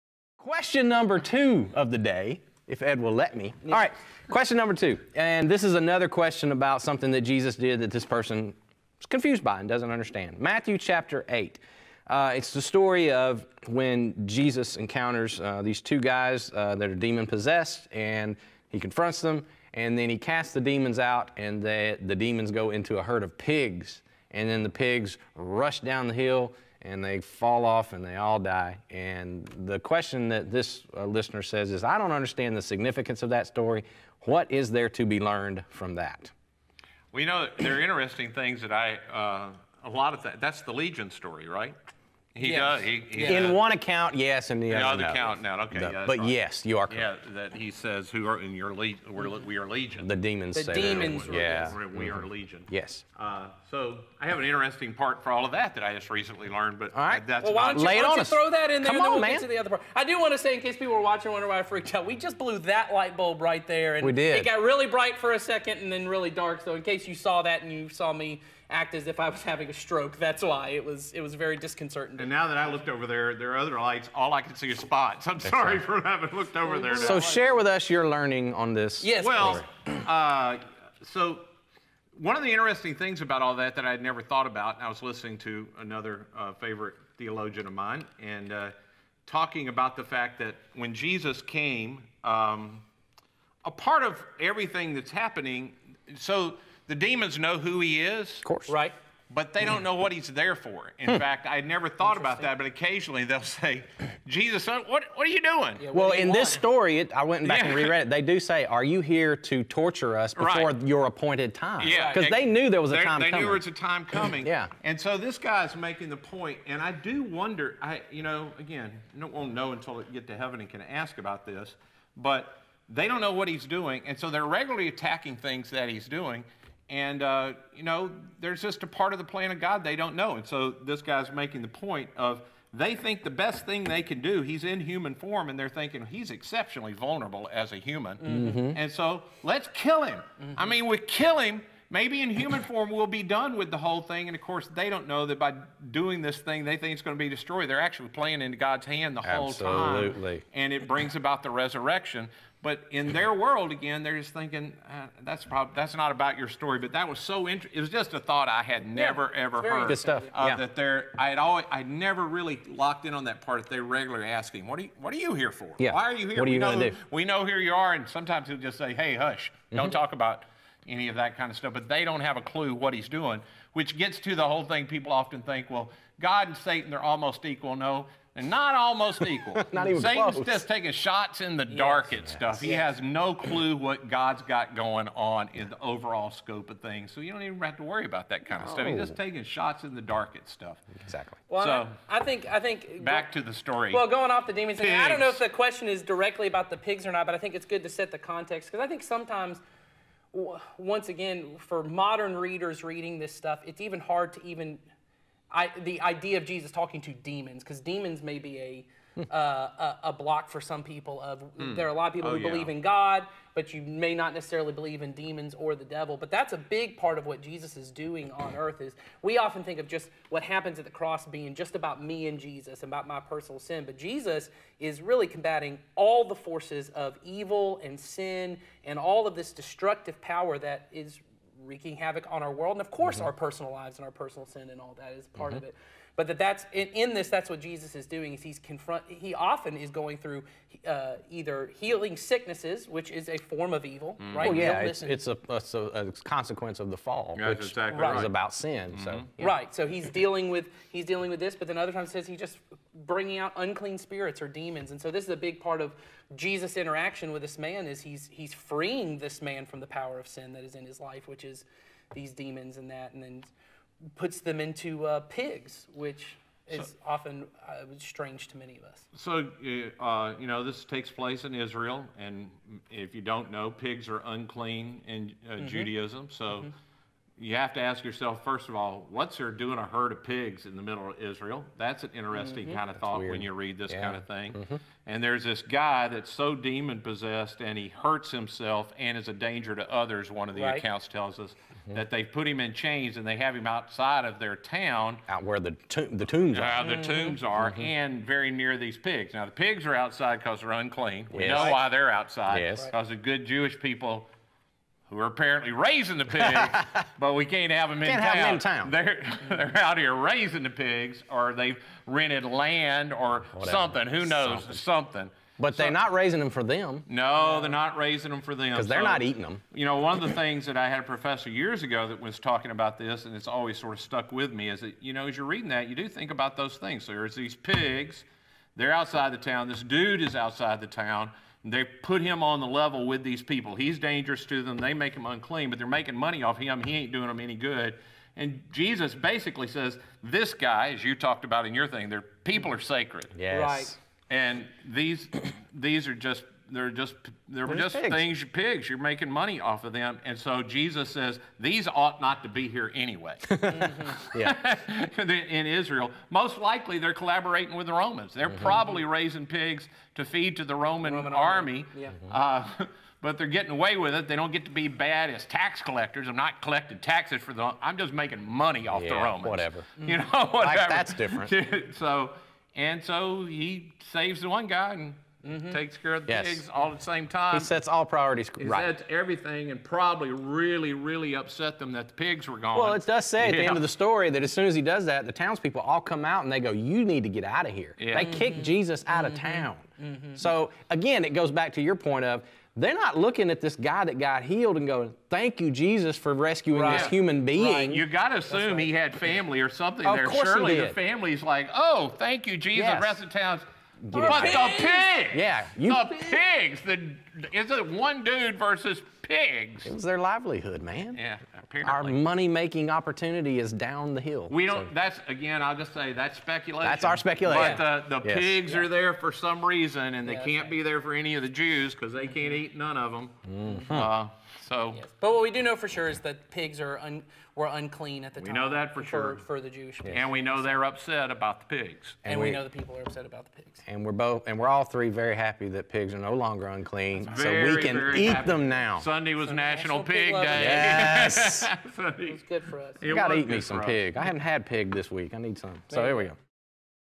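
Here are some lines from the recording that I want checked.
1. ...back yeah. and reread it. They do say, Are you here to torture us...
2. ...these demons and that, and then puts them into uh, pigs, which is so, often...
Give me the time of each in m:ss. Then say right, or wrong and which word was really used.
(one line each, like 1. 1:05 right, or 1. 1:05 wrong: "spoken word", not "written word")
1. 1:47 right
2. 4:22 right.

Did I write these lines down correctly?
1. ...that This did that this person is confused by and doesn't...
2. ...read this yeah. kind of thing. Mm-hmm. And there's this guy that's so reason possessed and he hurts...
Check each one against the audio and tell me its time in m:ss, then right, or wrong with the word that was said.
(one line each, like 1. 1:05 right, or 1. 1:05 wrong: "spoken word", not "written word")
1. 0:07 wrong: "Jesus", not "This"
2. 4:43 wrong: "demon", not "reason".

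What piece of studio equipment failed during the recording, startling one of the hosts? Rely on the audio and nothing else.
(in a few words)
light bulb.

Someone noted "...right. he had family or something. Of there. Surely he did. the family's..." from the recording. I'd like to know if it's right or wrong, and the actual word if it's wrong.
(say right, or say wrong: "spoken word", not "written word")
right.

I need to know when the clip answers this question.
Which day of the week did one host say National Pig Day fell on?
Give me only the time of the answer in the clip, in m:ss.
7:18.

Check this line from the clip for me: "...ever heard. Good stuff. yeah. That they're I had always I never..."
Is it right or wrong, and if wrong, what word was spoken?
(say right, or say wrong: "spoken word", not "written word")
right.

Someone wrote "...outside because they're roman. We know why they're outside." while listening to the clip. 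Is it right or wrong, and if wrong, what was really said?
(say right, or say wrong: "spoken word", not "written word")
wrong: "unclean", not "roman".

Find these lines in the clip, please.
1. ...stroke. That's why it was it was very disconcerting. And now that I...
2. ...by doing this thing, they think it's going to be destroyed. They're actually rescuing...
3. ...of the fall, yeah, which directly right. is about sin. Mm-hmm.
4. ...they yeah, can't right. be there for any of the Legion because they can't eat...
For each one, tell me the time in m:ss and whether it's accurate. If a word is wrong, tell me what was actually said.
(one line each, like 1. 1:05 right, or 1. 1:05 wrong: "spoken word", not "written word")
1. 1:09 right
2. 2:25 wrong: "playing", not "rescuing"
3. 4:06 wrong: "exactly", not "directly"
4. 7:00 wrong: "Jews", not "Legion".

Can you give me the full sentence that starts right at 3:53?
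our personal lives and our personal sin and all that is part mm-hmm.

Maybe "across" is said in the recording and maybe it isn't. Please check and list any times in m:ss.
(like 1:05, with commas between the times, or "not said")
not said.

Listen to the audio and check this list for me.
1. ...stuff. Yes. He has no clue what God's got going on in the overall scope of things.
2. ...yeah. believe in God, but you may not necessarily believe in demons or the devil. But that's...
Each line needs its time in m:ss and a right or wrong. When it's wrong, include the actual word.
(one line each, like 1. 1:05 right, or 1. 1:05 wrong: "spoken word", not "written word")
1. 3:02 right
2. 3:32 right.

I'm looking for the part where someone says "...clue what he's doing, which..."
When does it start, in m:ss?
2:52.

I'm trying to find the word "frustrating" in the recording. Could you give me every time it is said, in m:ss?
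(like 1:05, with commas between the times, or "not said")
not said.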